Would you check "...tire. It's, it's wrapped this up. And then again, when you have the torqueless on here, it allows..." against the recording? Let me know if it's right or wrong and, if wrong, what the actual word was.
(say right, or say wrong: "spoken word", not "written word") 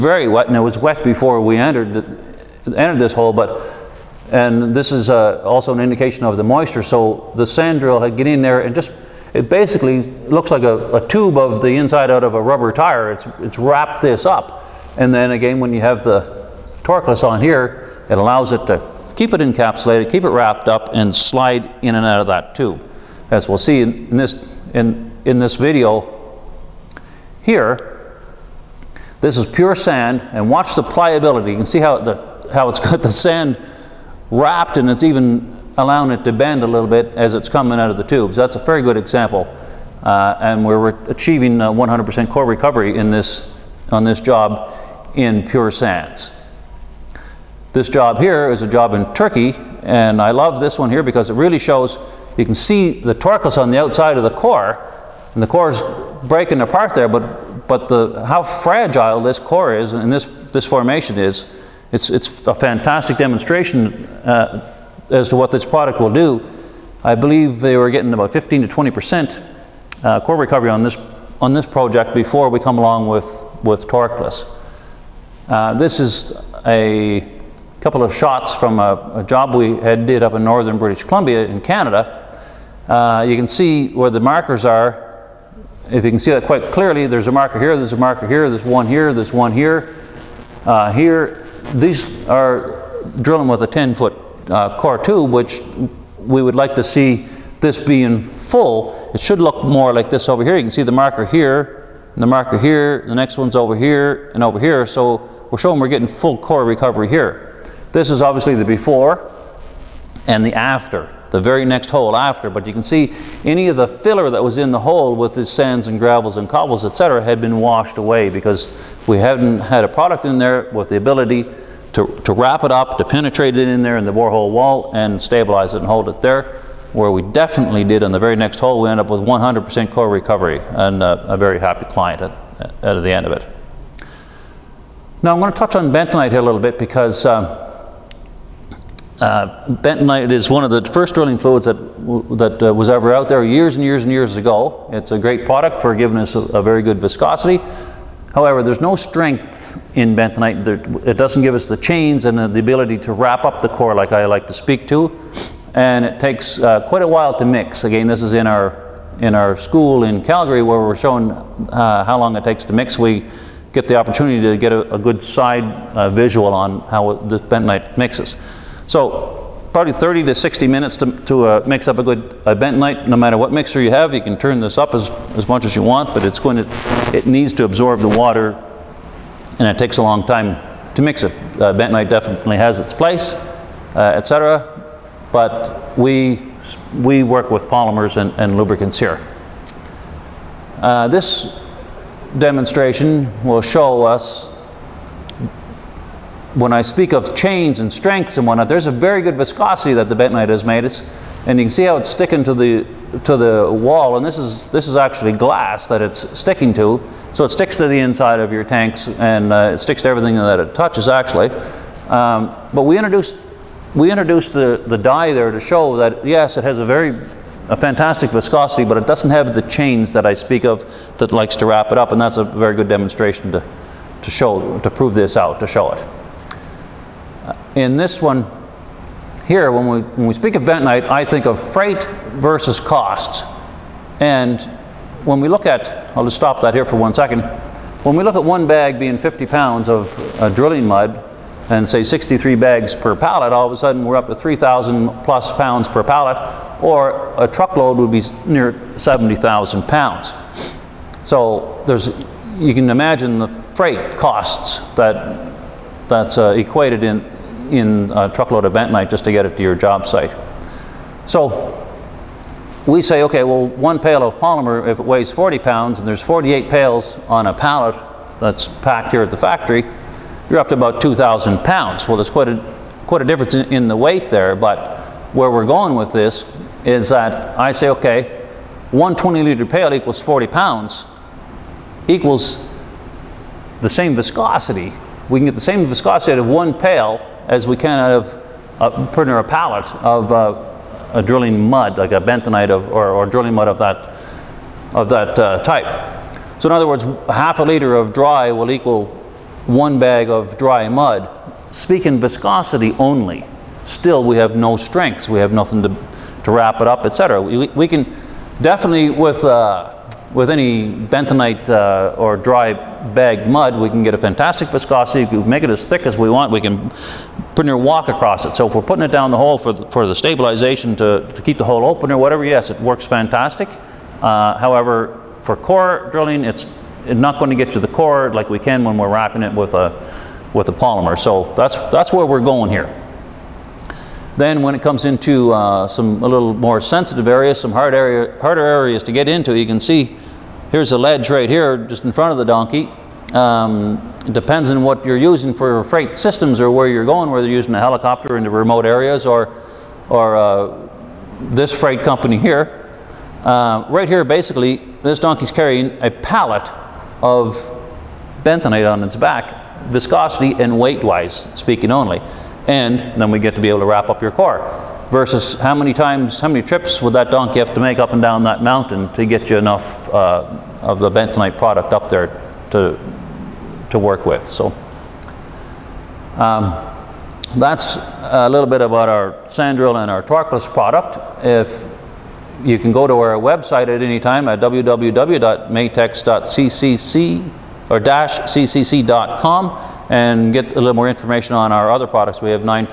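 right.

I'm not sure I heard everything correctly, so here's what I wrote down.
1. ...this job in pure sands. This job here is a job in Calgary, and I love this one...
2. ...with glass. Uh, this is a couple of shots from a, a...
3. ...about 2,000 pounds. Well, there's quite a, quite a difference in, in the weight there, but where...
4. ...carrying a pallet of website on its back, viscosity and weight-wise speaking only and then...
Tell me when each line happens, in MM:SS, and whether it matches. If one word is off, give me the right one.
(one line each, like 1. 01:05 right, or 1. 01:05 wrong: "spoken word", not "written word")
1. 00:44 wrong: "Turkey", not "Calgary"
2. 01:13 wrong: "torqueless", not "glass"
3. 04:30 right
4. 05:55 wrong: "bentonite", not "website".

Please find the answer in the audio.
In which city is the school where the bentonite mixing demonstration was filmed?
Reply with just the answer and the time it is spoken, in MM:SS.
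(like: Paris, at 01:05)
Calgary, at 02:40.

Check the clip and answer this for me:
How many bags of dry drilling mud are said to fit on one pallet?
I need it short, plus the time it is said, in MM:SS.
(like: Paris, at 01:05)
63, at 04:02.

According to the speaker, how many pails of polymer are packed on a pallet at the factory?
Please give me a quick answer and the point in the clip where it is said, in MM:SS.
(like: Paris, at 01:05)
48, at 04:26.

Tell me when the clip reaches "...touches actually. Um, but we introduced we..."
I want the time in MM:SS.
03:30.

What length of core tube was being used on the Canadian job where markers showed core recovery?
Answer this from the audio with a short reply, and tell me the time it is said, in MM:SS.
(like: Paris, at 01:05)
10-foot, at 01:33.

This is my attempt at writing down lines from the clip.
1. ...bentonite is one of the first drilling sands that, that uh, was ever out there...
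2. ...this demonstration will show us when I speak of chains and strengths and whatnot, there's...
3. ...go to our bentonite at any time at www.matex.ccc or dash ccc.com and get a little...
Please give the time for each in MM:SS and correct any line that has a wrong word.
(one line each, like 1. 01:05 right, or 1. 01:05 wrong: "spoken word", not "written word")
1. 02:19 wrong: "fluids", not "sands"
2. 03:11 right
3. 06:22 wrong: "website", not "bentonite".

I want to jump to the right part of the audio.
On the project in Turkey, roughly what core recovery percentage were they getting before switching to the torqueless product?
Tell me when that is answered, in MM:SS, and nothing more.
01:08.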